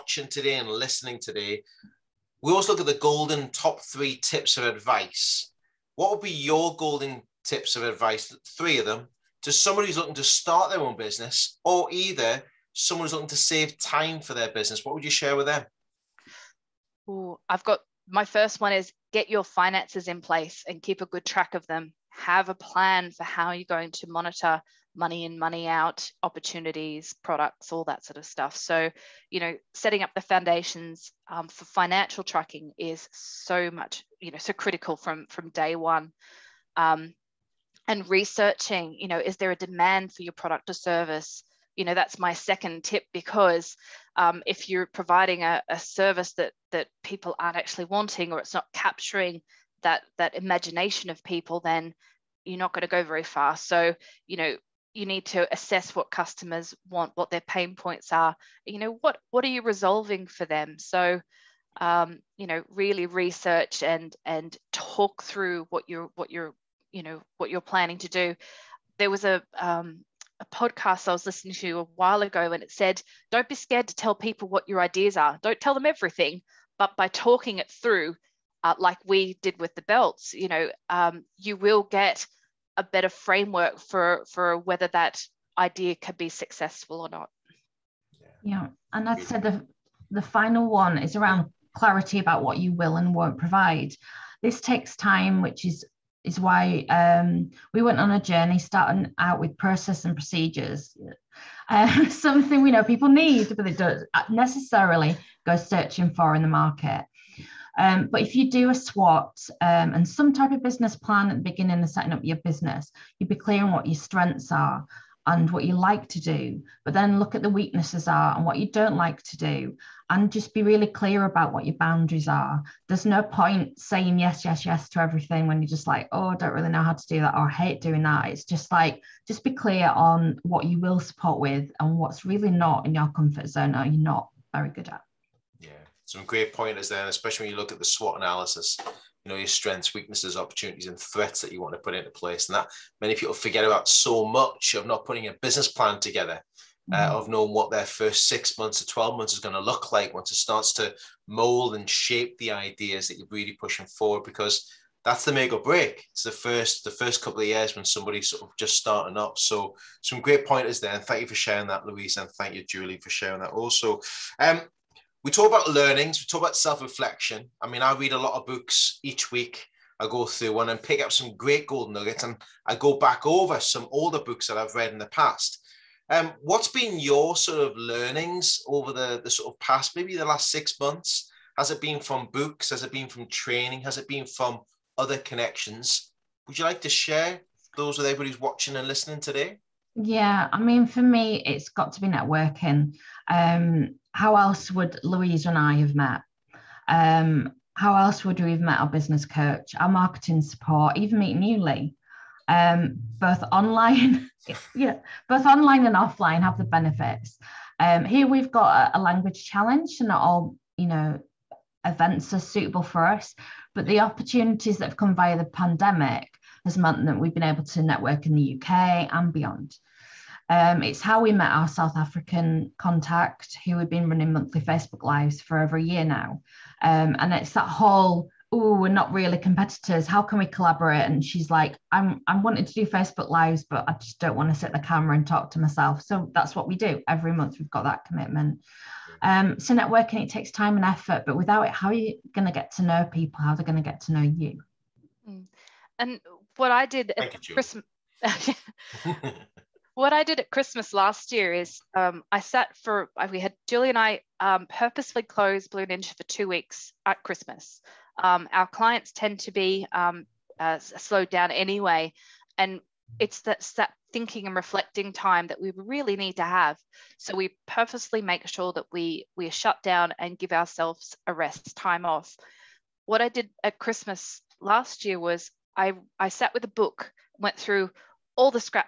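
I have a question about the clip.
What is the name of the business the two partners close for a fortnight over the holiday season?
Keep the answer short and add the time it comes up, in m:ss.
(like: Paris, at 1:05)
Blue Ninja, at 4:15.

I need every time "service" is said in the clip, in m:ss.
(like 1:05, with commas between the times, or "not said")
0:40, 0:45.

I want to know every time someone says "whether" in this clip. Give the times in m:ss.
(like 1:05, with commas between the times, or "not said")
1:24.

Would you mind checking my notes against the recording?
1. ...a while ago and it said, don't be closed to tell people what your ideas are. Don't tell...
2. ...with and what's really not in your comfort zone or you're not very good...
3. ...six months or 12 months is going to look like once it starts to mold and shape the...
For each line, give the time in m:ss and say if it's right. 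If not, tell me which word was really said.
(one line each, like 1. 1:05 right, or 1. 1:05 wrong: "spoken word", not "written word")
1. 1:11 wrong: "scared", not "closed"
2. 2:11 right
3. 2:28 right.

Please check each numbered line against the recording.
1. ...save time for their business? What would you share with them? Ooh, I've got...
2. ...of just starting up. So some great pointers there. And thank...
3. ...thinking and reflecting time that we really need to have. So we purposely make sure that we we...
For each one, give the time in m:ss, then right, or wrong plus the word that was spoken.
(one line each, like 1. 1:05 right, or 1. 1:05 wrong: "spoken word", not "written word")
1. 0:13 right
2. 2:38 right
3. 4:24 right.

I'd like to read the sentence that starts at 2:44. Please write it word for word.
Um, we talk about learnings, we talk about self-reflection.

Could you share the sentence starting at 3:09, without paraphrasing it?
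Yeah, I mean, for me, it's got to be networking.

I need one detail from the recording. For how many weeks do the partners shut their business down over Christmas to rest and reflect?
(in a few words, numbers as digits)
2.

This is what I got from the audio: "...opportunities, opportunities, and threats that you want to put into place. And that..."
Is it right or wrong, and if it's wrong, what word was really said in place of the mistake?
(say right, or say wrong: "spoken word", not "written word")
wrong: "weaknesses", not "opportunities".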